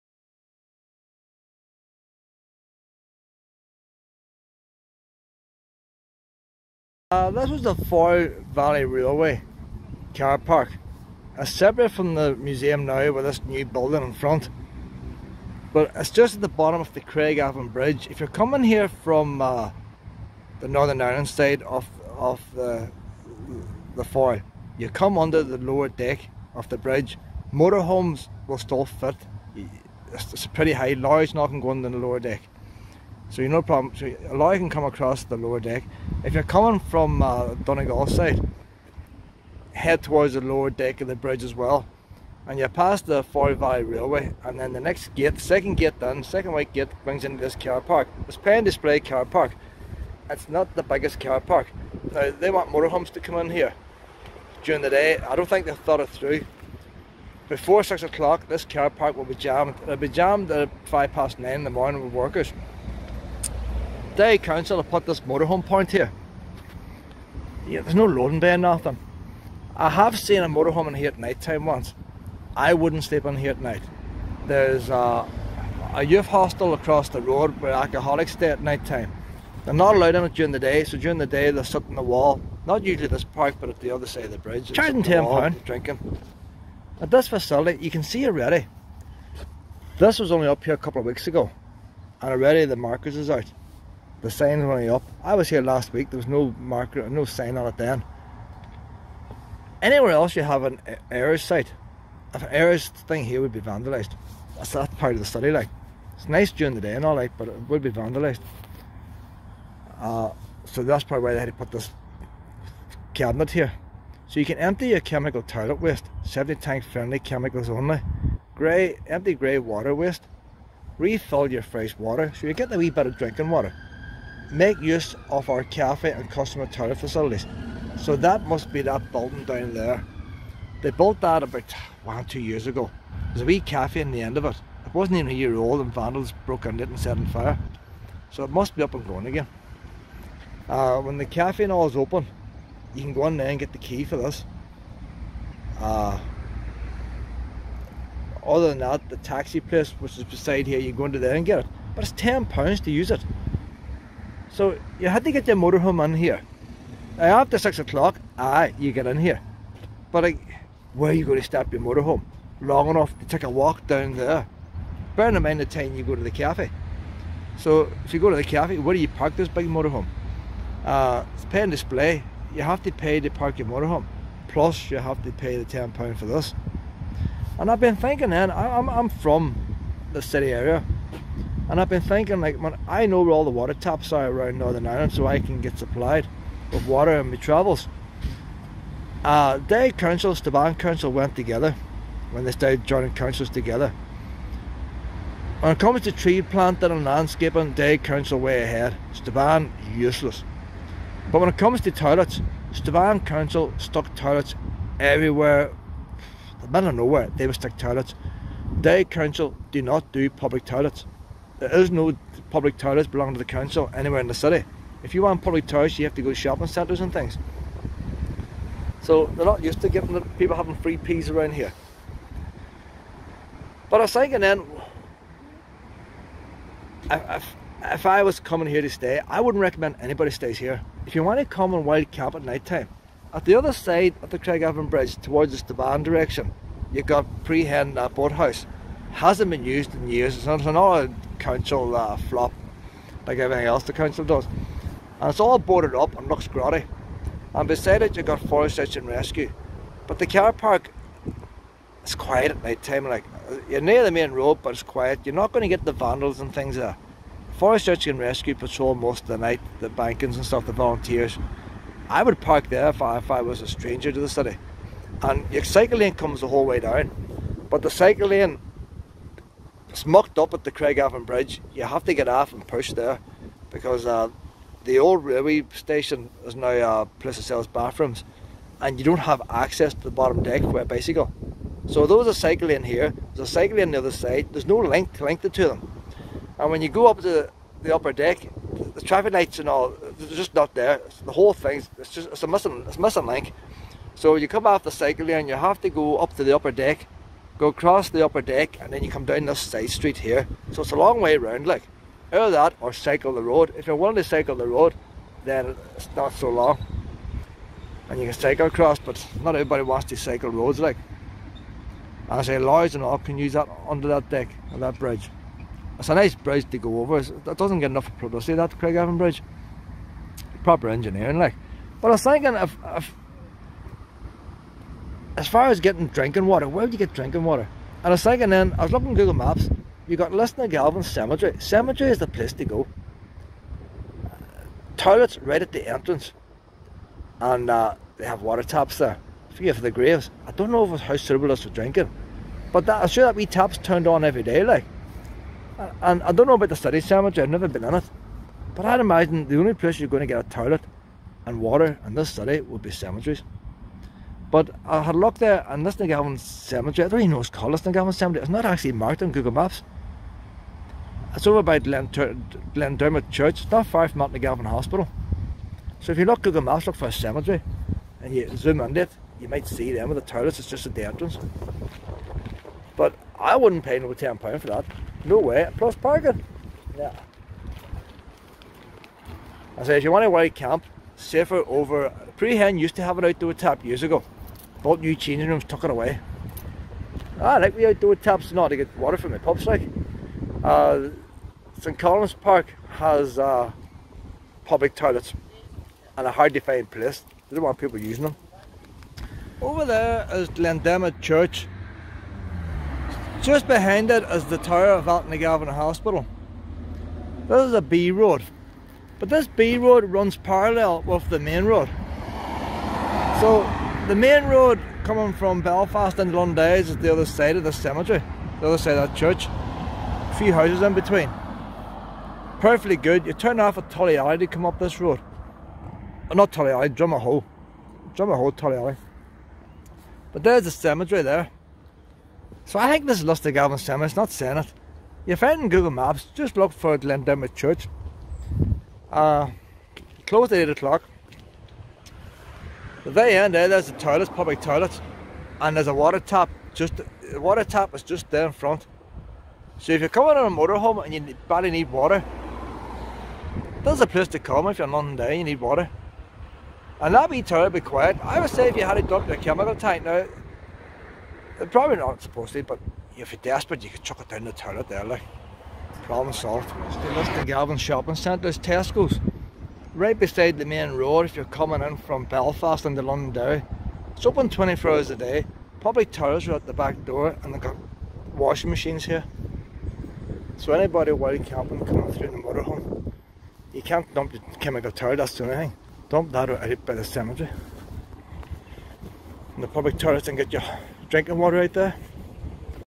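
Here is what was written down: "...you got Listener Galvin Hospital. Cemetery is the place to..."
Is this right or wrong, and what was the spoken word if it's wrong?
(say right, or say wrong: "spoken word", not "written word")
wrong: "Cemetery", not "Hospital".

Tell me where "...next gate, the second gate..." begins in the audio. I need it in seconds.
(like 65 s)
44 s.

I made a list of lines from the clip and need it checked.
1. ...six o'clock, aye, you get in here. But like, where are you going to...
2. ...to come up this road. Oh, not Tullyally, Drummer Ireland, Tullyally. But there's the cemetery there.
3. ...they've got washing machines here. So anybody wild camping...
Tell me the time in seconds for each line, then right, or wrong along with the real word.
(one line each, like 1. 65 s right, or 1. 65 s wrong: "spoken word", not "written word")
1. 157 s right
2. 424 s wrong: "Hole", not "Ireland"
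3. 477 s right.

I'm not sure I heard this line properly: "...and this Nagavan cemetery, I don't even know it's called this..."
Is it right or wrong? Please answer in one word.
right.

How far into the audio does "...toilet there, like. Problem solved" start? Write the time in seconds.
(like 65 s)
464 s.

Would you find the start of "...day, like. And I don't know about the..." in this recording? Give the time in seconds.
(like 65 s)
344 s.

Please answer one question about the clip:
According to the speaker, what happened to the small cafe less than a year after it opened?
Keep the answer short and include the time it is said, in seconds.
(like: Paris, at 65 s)
Set on fire, at 136 s.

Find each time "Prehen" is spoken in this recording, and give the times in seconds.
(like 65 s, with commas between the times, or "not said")
237 s, 382 s.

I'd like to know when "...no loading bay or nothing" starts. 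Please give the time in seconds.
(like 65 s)
67 s.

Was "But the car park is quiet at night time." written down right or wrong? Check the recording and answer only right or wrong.
right.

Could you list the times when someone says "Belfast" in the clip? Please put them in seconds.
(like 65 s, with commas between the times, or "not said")
415 s, 472 s.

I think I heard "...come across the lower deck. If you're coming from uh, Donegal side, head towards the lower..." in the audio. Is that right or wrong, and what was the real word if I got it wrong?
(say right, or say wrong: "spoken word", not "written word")
right.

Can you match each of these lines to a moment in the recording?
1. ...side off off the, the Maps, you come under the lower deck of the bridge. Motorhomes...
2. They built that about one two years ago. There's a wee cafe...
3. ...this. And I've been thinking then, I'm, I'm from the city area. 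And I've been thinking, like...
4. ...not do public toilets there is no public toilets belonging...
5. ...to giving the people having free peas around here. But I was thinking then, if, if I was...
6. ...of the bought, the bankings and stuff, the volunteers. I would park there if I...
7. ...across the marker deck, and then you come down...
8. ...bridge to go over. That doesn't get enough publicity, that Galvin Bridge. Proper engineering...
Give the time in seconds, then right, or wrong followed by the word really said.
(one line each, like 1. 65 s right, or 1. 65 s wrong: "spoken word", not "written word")
1. 21 s wrong: "Foyle", not "Maps"
2. 130 s right
3. 176 s right
4. 209 s right
5. 219 s right
6. 259 s wrong: "night", not "bought"
7. 297 s wrong: "upper", not "marker"
8. 316 s wrong: "Craigavon", not "Galvin".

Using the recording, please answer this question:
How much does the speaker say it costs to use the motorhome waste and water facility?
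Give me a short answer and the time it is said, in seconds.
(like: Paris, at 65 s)
£10, at 85 s.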